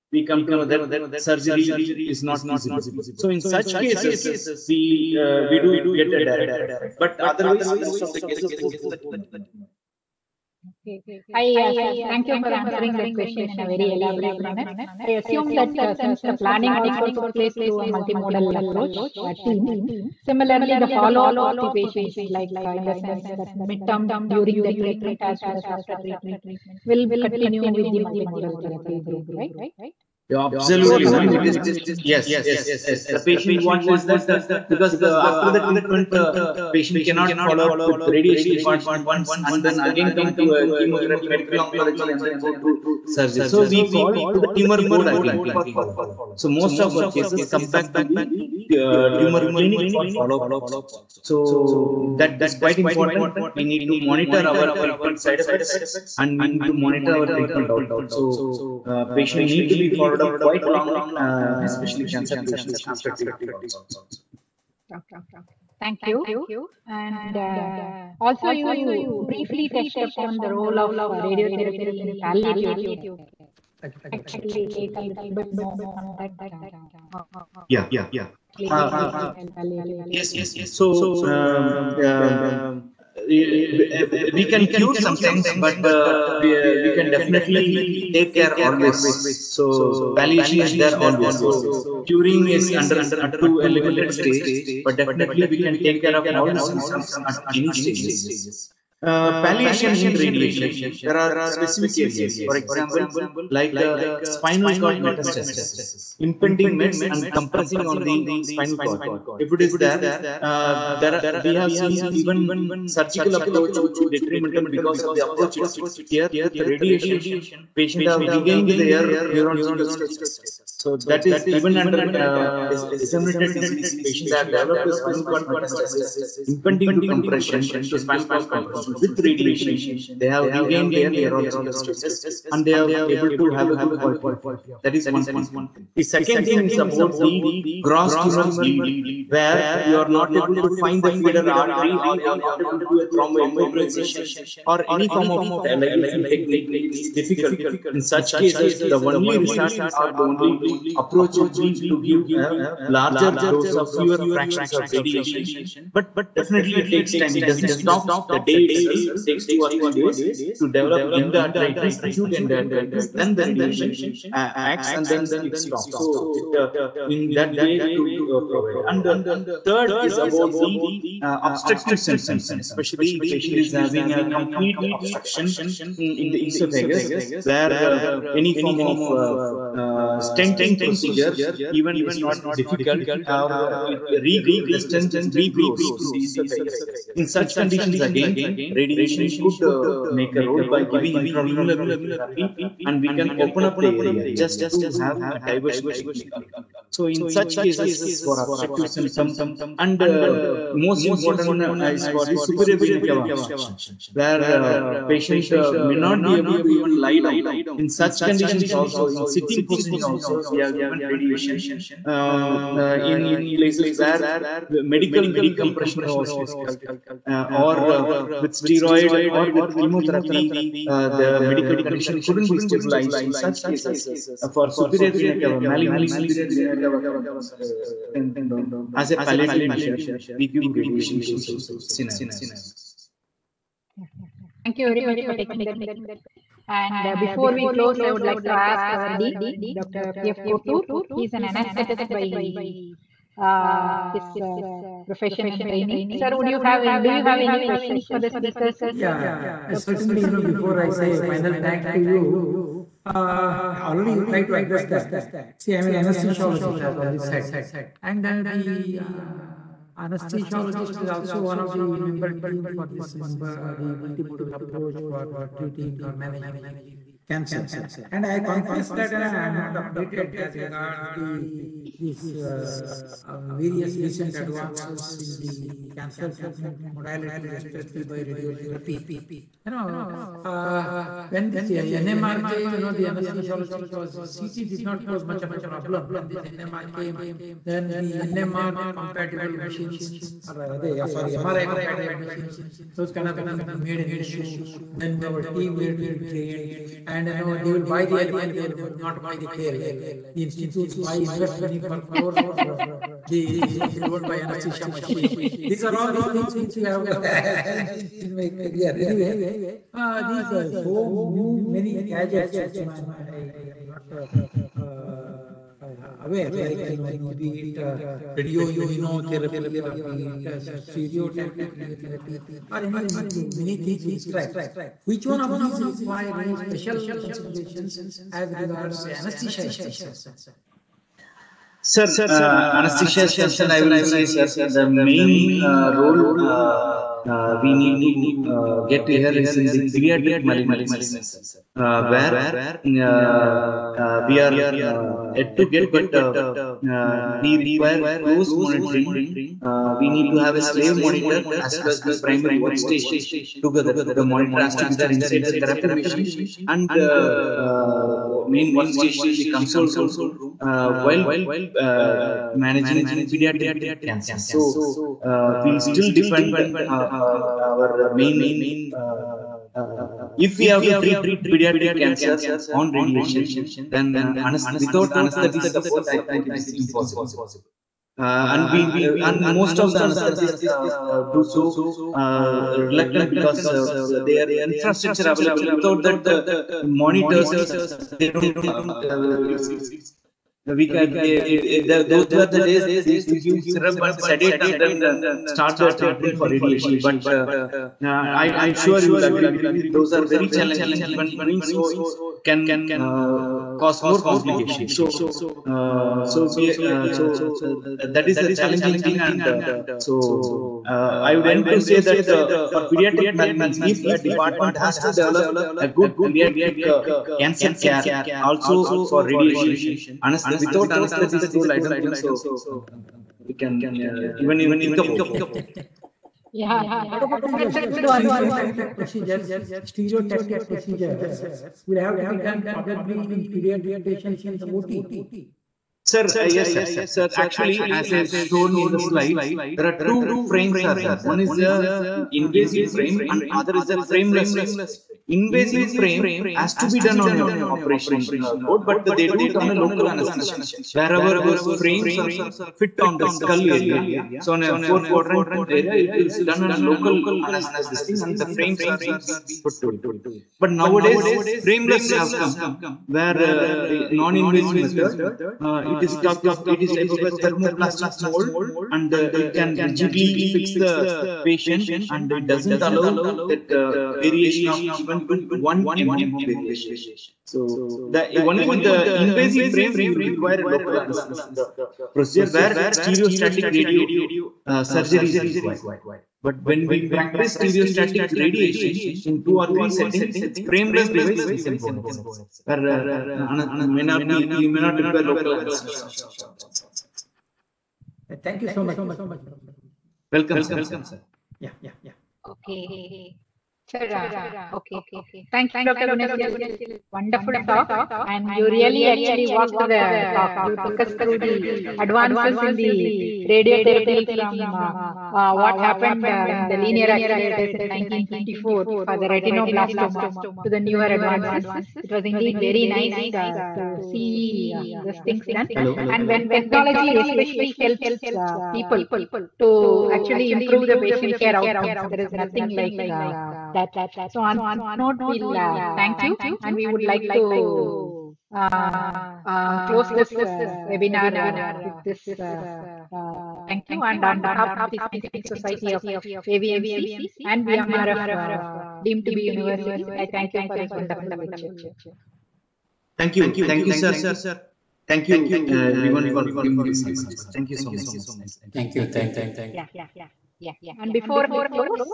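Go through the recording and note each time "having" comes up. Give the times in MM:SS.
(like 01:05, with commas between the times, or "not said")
02:53.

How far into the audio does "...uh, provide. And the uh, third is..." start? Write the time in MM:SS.
02:48.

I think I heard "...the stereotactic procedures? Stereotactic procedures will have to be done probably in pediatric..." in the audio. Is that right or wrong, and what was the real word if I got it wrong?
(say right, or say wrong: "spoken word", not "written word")
right.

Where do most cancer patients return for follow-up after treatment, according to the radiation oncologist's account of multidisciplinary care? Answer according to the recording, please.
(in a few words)
Tumor clinic.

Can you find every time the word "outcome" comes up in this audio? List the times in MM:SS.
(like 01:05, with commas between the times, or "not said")
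00:57, 08:51.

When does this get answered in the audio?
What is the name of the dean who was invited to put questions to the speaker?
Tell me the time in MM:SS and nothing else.
03:59.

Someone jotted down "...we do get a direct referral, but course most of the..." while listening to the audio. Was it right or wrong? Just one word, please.
wrong.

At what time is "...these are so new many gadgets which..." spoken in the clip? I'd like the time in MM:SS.
05:10.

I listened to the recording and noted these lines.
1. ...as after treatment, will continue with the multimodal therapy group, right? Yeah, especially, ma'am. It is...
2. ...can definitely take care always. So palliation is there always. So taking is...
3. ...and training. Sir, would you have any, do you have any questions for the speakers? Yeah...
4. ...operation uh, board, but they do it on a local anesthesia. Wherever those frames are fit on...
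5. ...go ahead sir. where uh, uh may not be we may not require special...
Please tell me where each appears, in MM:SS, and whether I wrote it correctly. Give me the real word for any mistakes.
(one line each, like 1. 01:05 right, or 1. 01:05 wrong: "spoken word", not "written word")
1. 00:25 wrong: "absolutely", not "especially"
2. 01:26 wrong: "curing", not "taking"
3. 04:05 right
4. 07:27 right
5. 08:11 wrong: "local", not "special".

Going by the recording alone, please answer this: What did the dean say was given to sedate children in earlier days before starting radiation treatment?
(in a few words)
Syrup.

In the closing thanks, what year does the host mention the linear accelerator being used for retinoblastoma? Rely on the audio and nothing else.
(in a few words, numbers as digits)
1954.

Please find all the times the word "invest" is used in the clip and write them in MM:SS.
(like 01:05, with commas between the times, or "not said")
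05:01.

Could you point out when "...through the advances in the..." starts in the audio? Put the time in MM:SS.
08:31.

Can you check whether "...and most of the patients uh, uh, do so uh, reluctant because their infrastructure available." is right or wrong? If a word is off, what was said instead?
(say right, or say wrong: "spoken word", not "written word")
wrong: "anesthetists", not "patients".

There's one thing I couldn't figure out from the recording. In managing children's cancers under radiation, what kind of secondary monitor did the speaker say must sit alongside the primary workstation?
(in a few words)
Slave monitor.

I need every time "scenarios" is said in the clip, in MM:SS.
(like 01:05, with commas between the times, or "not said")
03:51.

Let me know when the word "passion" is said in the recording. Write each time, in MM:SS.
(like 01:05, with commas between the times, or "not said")
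not said.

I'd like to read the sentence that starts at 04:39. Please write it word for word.
You know, uh, when this uh, NMR came, you know, the anesthesiologist was CT did not pose much of a problem.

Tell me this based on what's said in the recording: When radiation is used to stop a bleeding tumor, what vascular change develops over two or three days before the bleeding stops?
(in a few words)
Acute endarteritis.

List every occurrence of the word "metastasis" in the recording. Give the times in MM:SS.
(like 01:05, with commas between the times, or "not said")
01:45, 02:05.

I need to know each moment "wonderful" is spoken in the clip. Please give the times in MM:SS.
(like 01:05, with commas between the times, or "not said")
08:27, 09:10.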